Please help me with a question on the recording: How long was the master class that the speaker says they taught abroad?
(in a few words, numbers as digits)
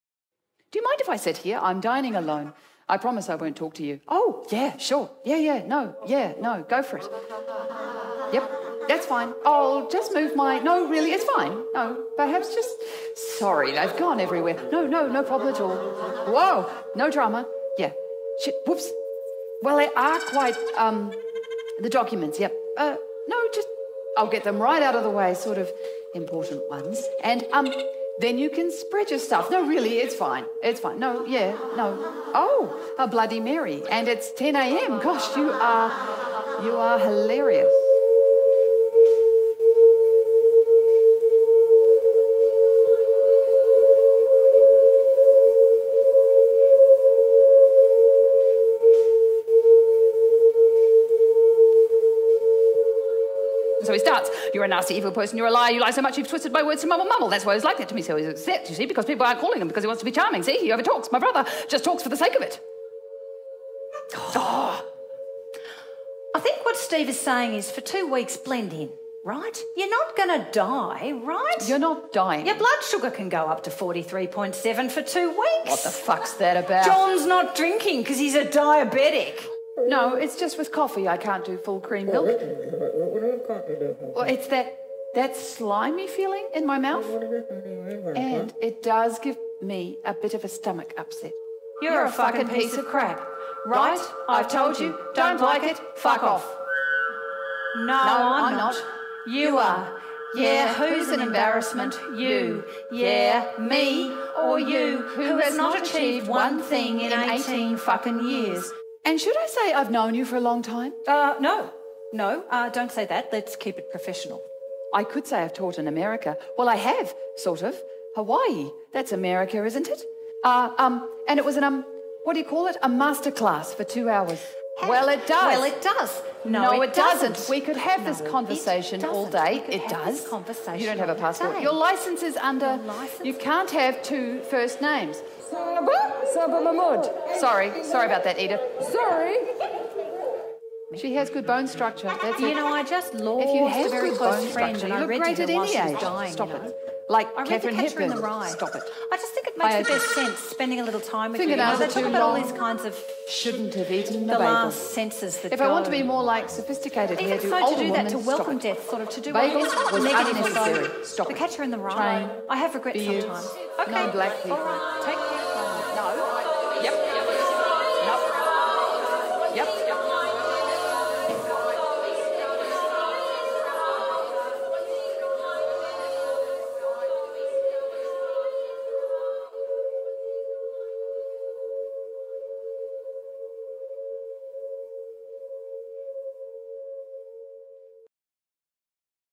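two hours.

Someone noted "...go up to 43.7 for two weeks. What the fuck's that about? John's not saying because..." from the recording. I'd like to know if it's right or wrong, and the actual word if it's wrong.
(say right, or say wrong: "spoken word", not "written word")
wrong: "drinking", not "saying".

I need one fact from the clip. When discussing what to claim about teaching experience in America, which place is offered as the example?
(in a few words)
Hawaii.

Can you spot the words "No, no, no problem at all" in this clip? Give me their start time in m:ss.
0:14.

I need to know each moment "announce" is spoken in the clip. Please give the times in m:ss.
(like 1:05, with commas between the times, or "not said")
not said.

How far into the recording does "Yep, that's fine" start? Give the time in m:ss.
0:08.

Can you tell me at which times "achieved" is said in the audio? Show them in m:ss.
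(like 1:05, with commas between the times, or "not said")
1:45.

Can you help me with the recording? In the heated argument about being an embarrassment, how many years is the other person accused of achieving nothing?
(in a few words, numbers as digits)
18.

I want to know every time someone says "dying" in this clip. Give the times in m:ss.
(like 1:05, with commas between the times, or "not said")
1:12, 2:26.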